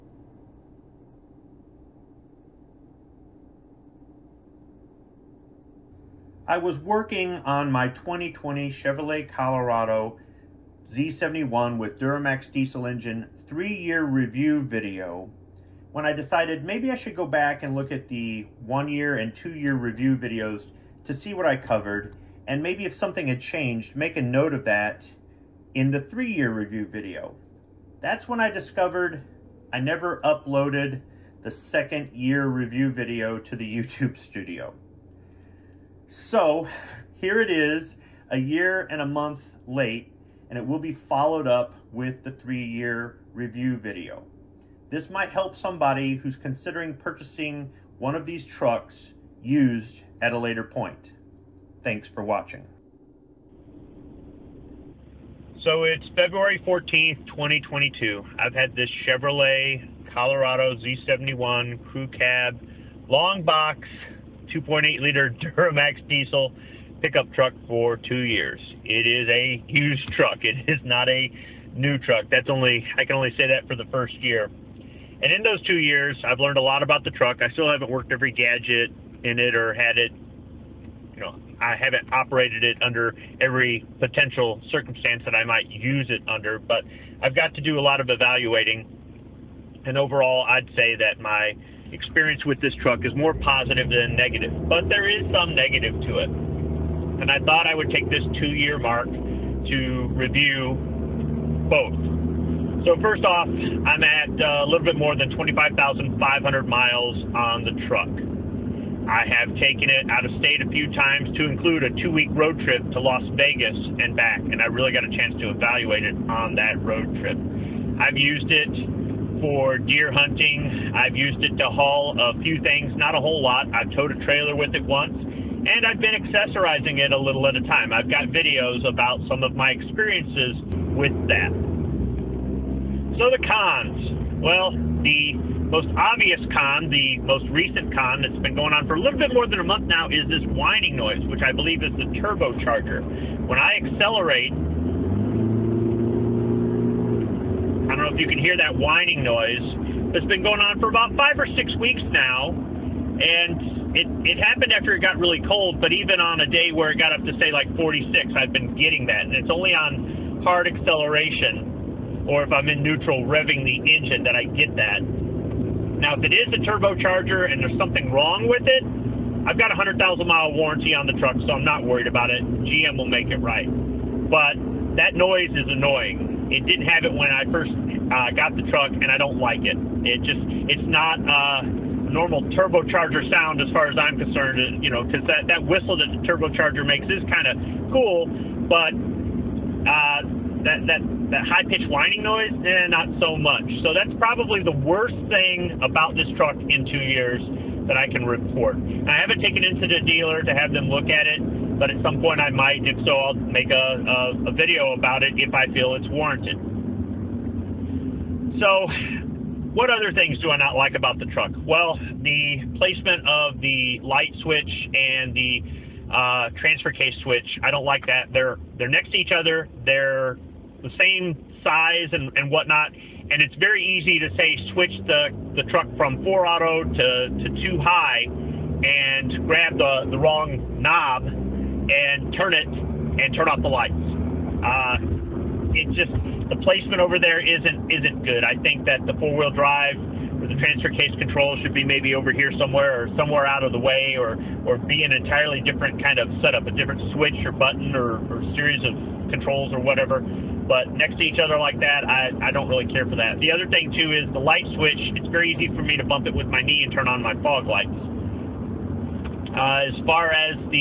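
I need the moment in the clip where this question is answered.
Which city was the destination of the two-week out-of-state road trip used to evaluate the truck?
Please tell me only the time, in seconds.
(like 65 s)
112 s.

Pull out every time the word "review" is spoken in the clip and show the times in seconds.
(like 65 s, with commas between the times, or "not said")
14 s, 19 s, 26 s, 32 s, 43 s, 100 s.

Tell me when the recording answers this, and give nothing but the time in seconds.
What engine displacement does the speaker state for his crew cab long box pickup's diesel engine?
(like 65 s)
64 s.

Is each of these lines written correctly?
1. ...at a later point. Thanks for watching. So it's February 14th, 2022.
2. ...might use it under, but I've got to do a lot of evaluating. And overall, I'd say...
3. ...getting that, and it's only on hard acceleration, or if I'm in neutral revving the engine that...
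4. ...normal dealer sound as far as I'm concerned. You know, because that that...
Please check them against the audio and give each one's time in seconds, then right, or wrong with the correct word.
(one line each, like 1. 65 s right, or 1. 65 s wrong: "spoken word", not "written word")
1. 50 s right
2. 85 s right
3. 158 s right
4. 181 s wrong: "turbocharger", not "dealer".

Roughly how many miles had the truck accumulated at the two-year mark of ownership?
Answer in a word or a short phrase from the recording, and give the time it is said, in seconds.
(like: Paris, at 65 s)
25,500, at 105 s.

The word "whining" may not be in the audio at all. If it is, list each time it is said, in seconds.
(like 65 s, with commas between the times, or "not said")
140 s, 148 s, 191 s.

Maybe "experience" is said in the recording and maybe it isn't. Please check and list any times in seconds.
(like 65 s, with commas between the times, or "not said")
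91 s, 129 s.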